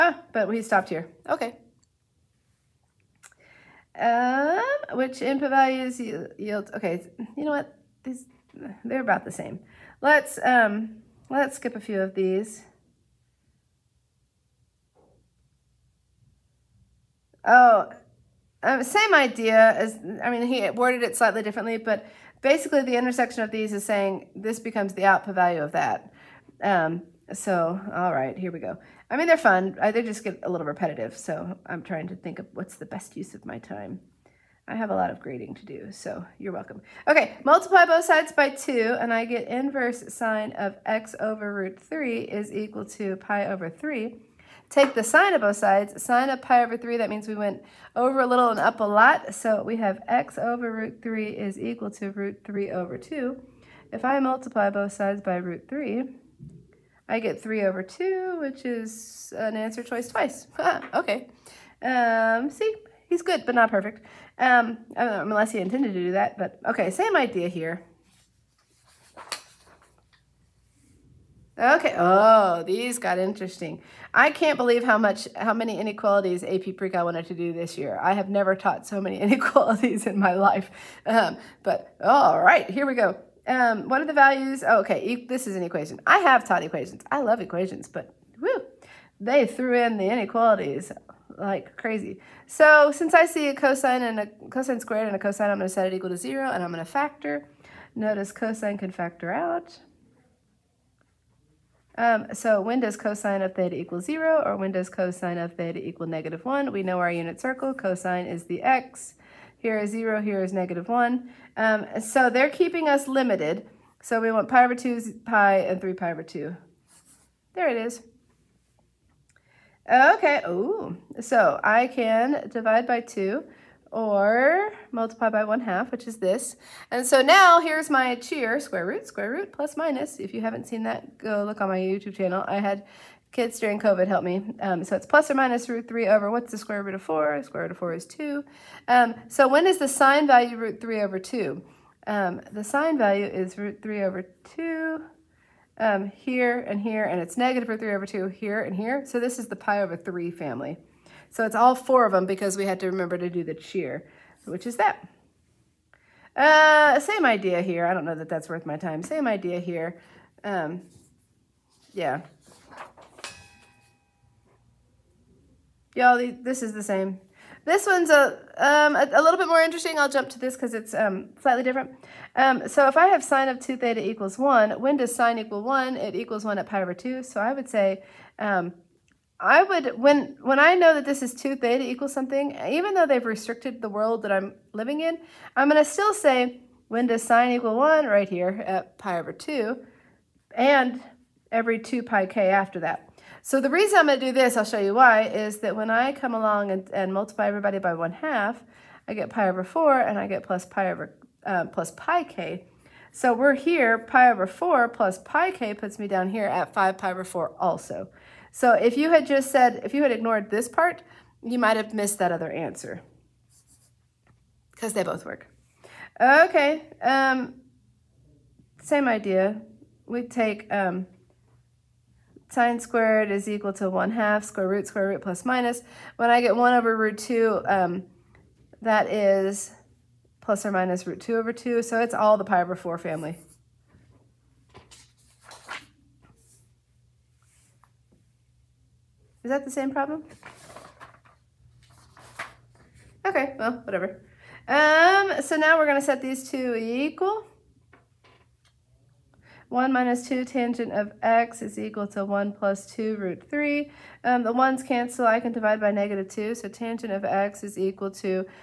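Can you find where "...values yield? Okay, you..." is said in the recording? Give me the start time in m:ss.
0:05.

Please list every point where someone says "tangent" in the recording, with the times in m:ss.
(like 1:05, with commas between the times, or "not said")
4:10, 4:16.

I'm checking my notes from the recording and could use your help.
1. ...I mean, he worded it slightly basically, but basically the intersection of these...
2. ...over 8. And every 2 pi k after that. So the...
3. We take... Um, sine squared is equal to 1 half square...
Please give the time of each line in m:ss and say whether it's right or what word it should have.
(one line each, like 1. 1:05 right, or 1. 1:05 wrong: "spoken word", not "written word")
1. 0:20 wrong: "differently", not "basically"
2. 3:09 wrong: "2", not "8"
3. 3:40 right.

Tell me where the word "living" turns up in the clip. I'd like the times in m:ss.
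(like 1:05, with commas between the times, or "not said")
3:04.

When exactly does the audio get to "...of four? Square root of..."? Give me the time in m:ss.
2:16.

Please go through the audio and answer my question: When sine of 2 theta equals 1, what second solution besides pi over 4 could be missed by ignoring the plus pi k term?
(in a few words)
5π/4.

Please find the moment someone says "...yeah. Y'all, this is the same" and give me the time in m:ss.
2:41.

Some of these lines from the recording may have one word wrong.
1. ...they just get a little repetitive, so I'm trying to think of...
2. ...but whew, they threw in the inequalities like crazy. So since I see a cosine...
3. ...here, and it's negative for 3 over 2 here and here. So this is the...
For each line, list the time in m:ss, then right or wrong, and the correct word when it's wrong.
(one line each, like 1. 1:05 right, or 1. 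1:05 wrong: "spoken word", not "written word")
1. 0:29 right
2. 1:27 right
3. 2:26 right.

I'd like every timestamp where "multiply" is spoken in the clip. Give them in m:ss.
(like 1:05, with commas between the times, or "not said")
0:37, 0:54, 2:04, 3:17.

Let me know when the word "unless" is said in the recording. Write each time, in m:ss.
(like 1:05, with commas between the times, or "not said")
1:04.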